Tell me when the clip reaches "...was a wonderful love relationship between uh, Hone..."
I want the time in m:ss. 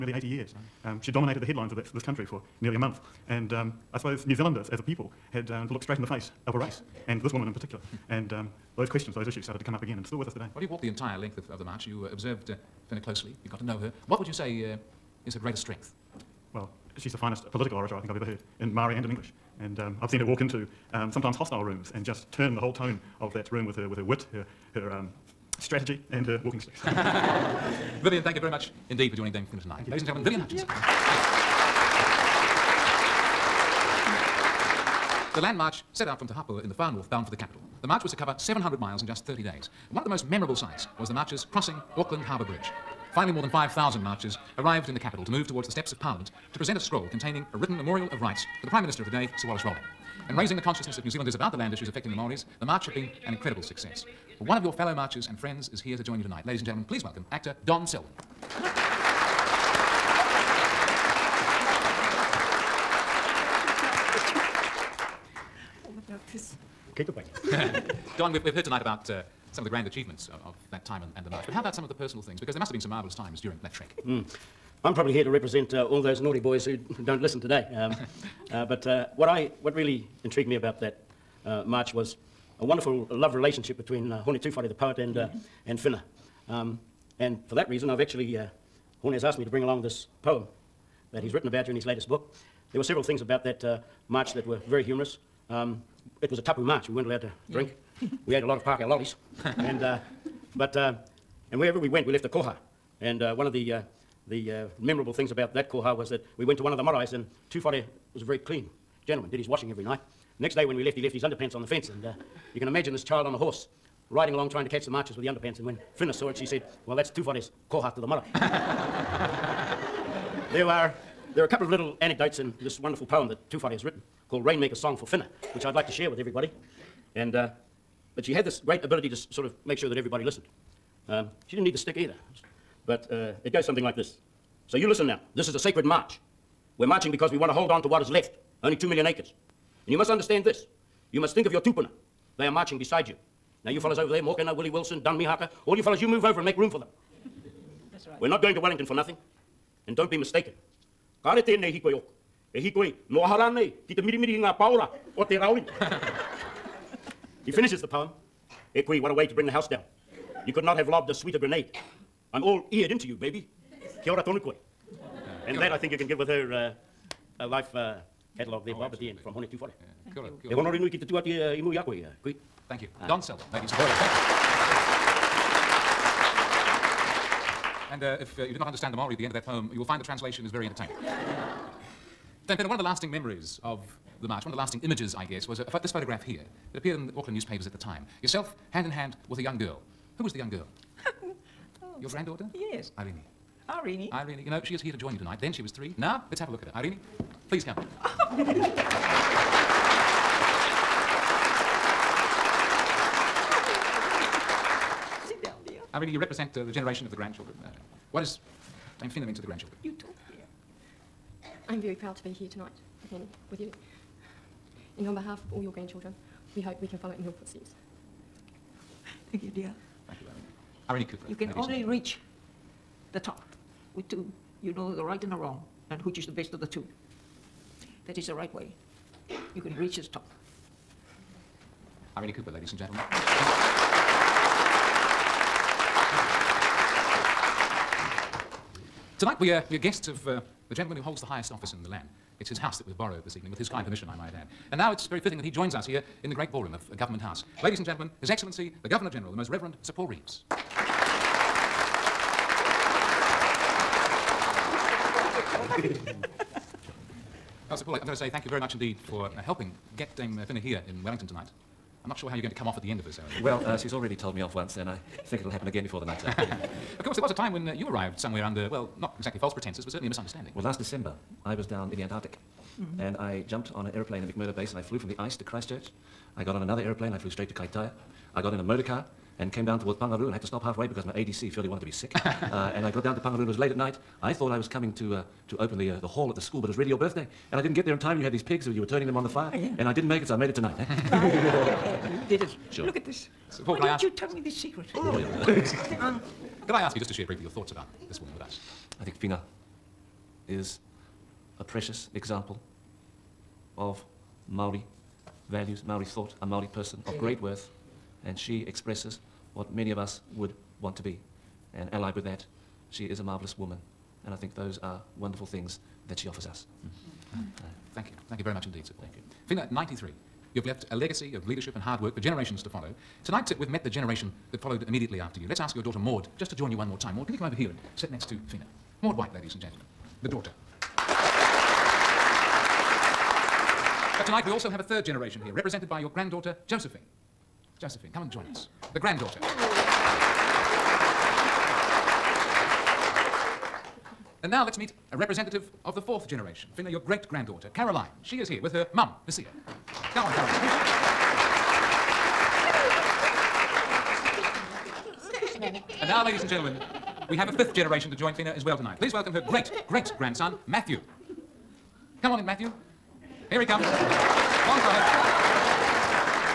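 1:21.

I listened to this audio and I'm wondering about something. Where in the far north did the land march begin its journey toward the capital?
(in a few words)
Te Hapua.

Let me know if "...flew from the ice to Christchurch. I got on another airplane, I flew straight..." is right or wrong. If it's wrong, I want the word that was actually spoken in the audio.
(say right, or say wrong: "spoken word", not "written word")
right.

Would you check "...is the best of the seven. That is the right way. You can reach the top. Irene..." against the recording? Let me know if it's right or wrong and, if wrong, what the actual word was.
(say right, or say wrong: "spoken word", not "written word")
wrong: "two", not "seven".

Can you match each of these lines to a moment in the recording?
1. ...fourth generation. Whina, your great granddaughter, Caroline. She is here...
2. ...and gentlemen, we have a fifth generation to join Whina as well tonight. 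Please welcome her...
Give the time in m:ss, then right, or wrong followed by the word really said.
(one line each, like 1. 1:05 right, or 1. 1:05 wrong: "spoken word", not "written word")
1. 5:45 right
2. 5:56 right.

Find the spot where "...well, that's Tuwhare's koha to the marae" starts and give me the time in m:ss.
1:56.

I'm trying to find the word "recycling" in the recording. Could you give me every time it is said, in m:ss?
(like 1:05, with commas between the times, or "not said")
not said.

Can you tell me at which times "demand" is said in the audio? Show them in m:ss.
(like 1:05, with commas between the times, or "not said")
not said.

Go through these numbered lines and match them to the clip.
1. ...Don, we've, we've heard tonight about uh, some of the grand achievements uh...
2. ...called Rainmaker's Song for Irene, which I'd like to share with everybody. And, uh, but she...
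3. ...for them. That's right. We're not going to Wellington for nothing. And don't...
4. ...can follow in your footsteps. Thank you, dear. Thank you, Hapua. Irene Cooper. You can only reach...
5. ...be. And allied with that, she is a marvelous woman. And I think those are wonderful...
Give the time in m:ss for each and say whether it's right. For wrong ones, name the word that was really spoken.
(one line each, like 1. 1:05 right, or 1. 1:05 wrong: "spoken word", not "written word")
1. 1:08 right
2. 2:04 wrong: "Whina", not "Irene"
3. 2:26 right
4. 3:36 wrong: "Irene", not "Hapua"
5. 5:11 right.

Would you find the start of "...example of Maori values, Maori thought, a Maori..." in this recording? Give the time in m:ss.
5:02.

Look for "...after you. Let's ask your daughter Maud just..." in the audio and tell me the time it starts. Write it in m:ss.
5:25.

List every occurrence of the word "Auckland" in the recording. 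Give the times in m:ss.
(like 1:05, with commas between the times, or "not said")
0:41, 3:07.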